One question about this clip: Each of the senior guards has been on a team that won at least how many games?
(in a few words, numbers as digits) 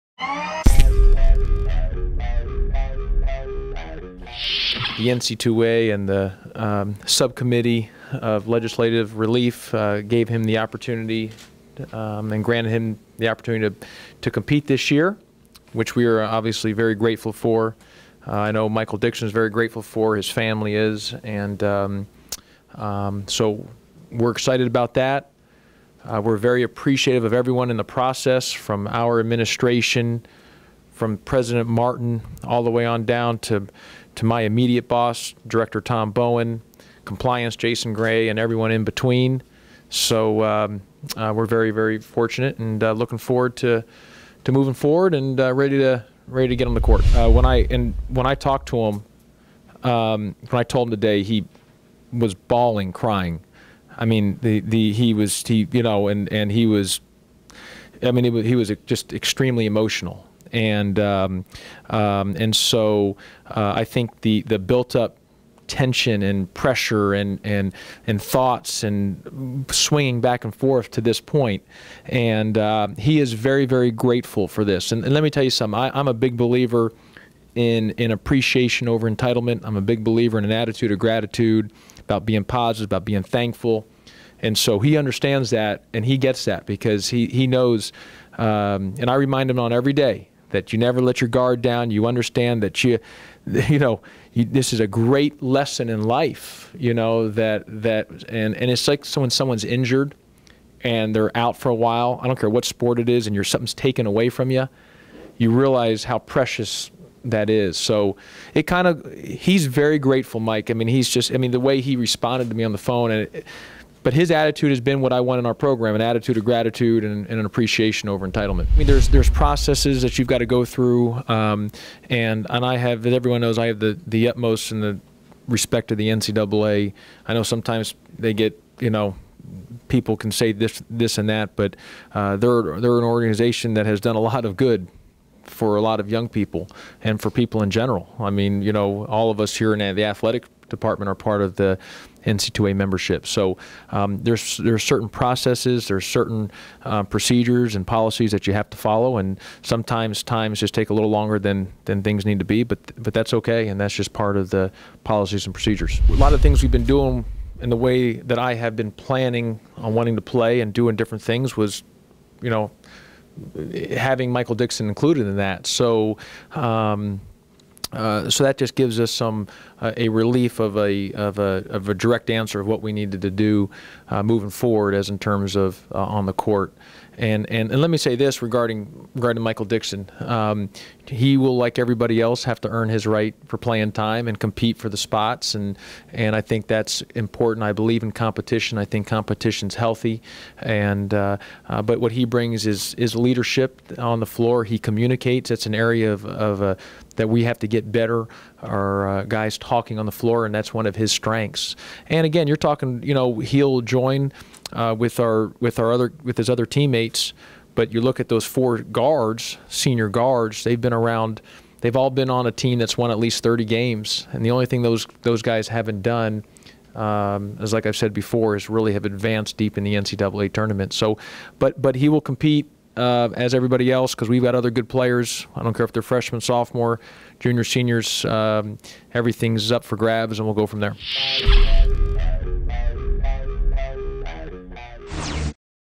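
30.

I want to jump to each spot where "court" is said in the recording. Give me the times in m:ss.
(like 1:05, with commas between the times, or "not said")
0:46, 2:56.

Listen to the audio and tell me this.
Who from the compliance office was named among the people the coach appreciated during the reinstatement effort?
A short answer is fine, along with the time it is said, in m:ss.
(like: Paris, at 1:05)
Jason Gray, at 0:37.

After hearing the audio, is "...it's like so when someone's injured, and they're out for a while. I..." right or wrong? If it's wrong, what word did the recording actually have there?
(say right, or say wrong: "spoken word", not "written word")
right.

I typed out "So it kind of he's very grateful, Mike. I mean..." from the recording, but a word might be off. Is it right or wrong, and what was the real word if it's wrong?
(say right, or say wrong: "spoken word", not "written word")
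right.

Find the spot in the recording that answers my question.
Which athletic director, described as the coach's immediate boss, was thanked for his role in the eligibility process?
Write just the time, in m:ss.
0:35.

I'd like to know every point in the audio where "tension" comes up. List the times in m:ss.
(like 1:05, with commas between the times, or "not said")
1:05.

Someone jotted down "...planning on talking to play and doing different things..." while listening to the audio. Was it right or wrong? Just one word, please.
wrong.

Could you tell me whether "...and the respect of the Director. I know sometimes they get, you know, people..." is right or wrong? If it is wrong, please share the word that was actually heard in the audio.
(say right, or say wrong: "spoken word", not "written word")
wrong: "NCAA", not "Director".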